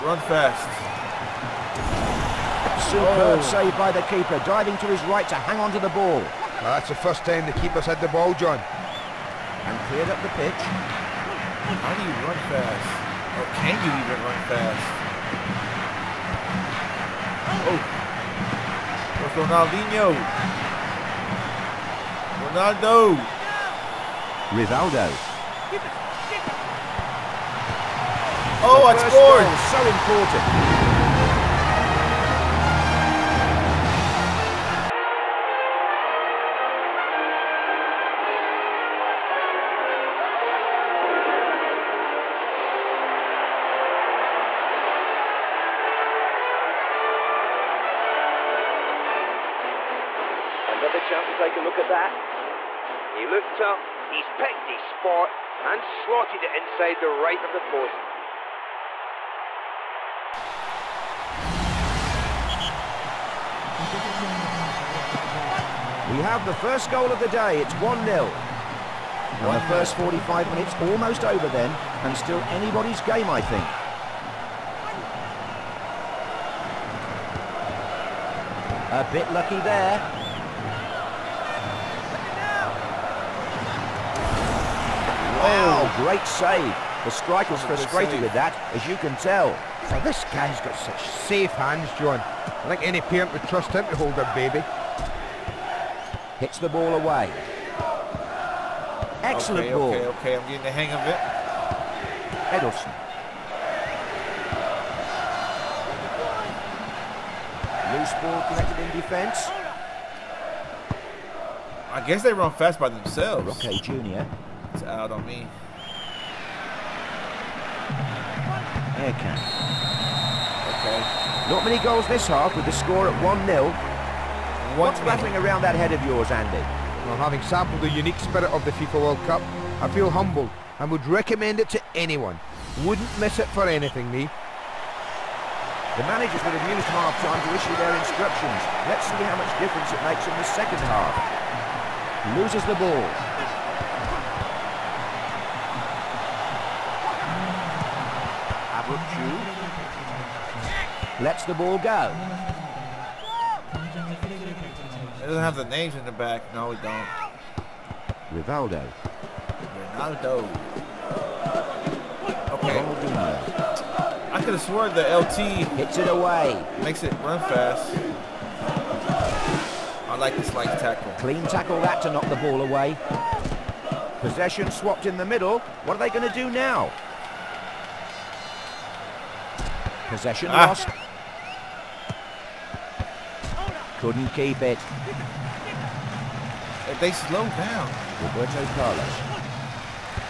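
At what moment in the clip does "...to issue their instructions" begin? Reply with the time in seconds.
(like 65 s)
137 s.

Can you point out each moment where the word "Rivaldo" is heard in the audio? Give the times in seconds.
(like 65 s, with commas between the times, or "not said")
24 s, 158 s.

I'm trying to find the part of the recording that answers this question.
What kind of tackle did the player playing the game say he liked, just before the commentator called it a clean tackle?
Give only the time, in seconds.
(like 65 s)
170 s.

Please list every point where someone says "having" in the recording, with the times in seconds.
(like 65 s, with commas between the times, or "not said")
127 s.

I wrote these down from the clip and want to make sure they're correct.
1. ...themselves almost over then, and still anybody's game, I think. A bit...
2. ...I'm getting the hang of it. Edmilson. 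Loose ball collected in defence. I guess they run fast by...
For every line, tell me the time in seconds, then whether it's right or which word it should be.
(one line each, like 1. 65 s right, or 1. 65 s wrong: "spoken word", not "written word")
1. 70 s wrong: "minutes", not "themselves"
2. 100 s right.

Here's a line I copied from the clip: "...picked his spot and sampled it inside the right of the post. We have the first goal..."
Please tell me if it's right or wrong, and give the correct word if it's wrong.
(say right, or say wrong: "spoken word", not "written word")
wrong: "slotted", not "sampled".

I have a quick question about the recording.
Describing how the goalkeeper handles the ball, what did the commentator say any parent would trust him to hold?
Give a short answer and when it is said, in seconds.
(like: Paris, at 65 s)
Their baby, at 94 s.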